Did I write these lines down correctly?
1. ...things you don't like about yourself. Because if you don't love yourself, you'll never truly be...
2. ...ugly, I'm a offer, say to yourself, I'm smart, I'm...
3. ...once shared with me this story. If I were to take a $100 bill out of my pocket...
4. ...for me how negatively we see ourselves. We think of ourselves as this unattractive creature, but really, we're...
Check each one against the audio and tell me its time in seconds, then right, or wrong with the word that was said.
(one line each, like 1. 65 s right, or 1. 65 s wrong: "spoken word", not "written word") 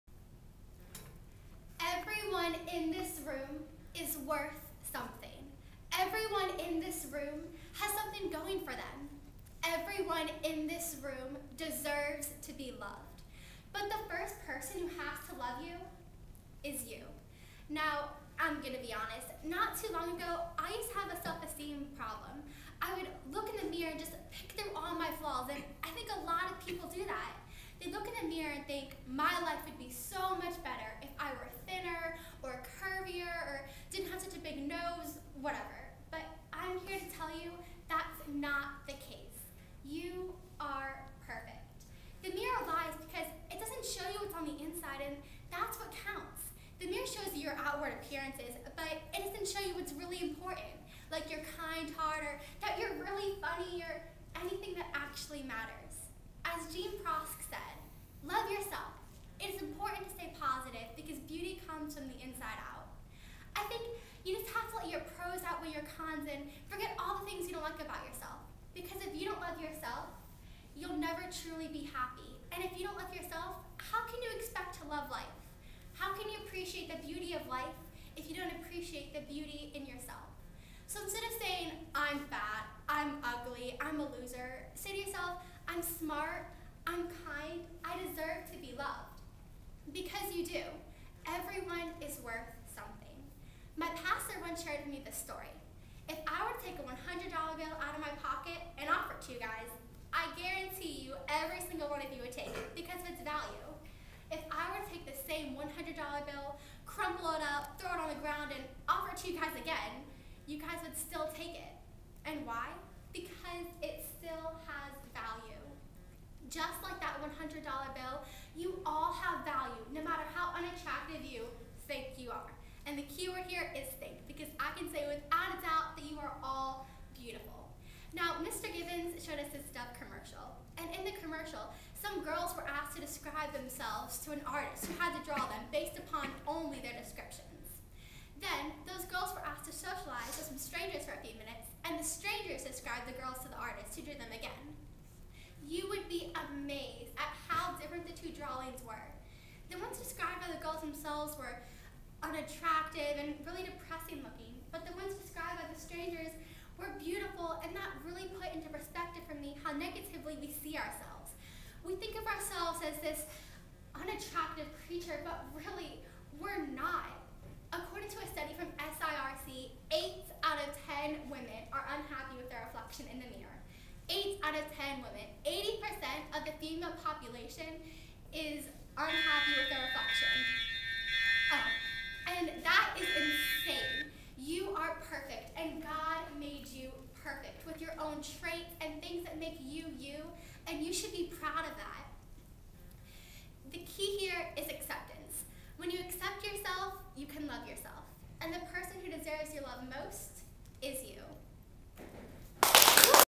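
1. 67 s right
2. 83 s wrong: "loser", not "offer"
3. 94 s right
4. 159 s right.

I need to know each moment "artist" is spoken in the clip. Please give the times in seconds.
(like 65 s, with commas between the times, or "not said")
134 s, 143 s.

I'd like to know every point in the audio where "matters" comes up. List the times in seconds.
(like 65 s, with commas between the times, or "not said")
55 s, 120 s.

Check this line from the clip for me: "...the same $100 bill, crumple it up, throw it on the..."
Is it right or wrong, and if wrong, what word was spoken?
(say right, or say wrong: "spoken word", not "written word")
right.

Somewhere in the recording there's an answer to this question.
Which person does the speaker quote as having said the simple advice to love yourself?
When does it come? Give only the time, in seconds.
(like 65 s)
56 s.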